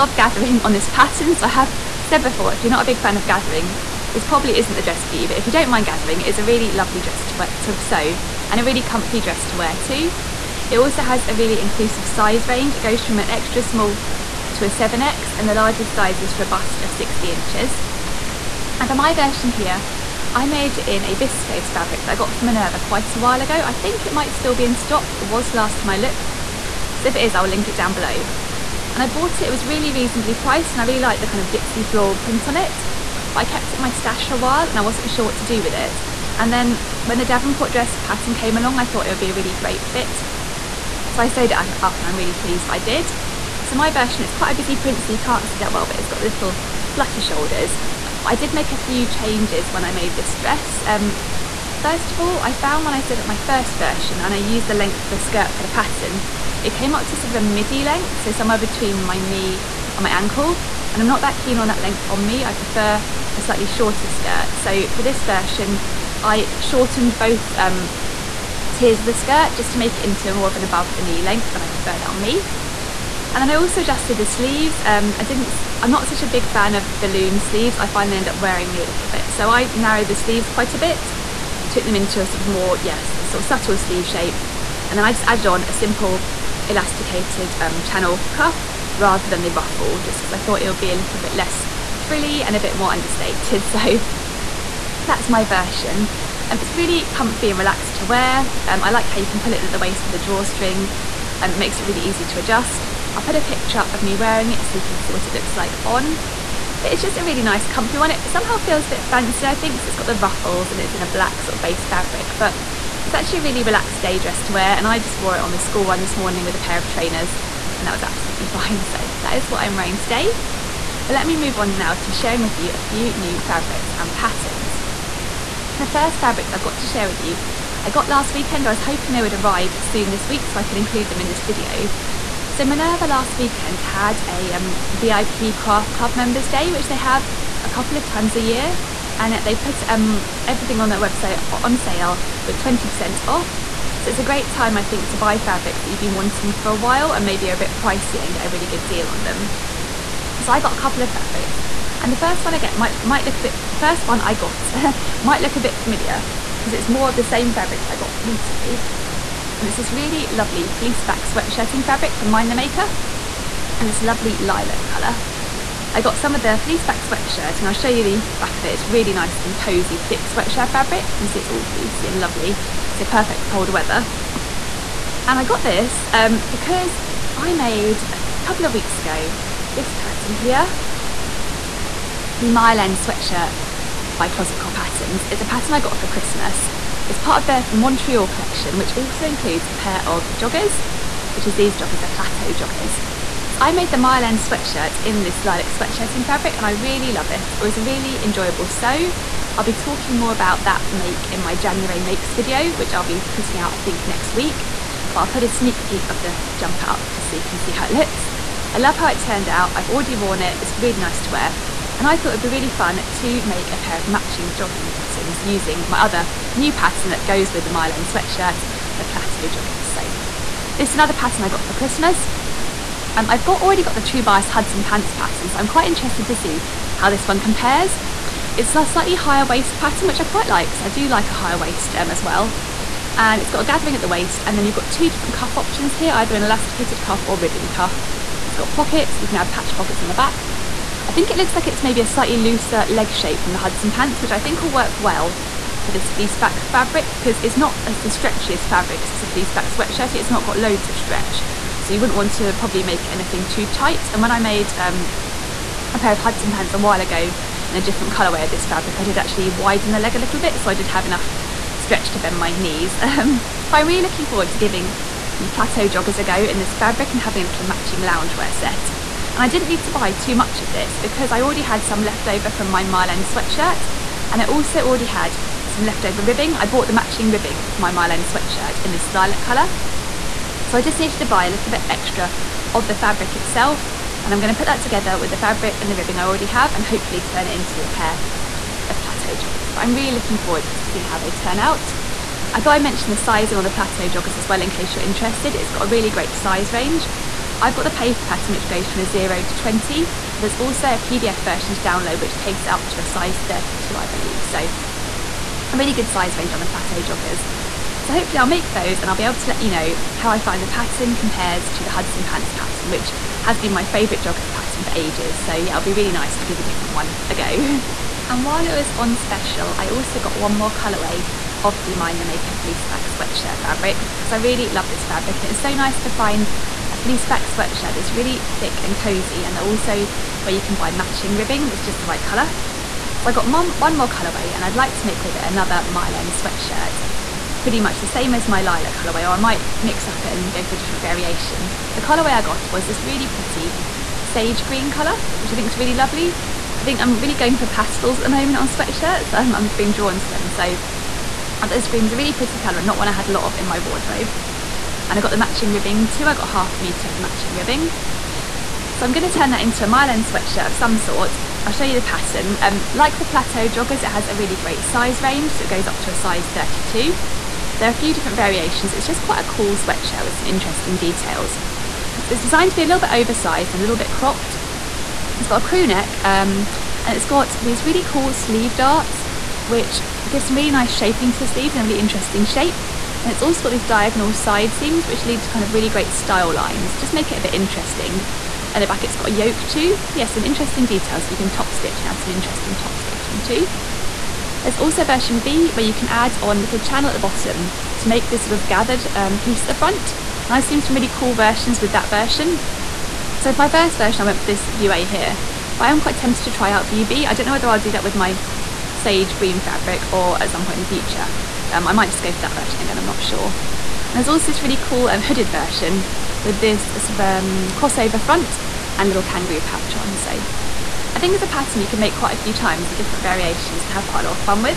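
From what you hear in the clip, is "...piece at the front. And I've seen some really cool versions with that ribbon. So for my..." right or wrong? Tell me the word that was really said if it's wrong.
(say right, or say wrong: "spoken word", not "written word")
wrong: "version", not "ribbon".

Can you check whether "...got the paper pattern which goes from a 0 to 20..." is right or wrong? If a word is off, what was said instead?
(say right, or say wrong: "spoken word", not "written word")
right.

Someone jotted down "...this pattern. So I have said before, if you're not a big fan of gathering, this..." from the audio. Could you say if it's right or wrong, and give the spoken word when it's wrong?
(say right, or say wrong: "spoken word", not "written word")
right.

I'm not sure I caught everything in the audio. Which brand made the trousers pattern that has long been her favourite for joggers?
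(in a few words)
True Bias.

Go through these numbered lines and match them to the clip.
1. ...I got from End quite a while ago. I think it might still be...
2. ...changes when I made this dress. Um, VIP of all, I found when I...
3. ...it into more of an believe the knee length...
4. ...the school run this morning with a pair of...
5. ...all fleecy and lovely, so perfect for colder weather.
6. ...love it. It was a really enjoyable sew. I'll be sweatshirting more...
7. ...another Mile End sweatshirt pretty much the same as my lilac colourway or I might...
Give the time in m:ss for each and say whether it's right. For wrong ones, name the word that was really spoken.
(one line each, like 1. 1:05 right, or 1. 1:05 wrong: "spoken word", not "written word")
1. 0:22 wrong: "Minerva", not "End"
2. 0:49 wrong: "First", not "VIP"
3. 1:09 wrong: "above", not "believe"
4. 1:55 right
5. 2:51 right
6. 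3:17 wrong: "talking", not "sweatshirting"
7. 5:35 right.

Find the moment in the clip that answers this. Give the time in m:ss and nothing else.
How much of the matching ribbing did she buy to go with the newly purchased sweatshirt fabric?
5:56.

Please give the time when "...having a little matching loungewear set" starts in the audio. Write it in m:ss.
4:27.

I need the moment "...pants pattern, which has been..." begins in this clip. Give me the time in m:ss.
5:12.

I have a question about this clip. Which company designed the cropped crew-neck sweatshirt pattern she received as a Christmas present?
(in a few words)
Closet Core Patterns.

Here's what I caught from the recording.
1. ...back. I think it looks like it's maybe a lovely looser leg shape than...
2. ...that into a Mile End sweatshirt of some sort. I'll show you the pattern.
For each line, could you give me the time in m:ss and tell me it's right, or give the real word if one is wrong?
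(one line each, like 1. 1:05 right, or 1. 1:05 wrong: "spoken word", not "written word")
1. 4:00 wrong: "slightly", not "lovely"
2. 5:59 right.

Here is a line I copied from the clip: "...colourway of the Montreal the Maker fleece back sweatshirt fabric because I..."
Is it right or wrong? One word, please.
wrong.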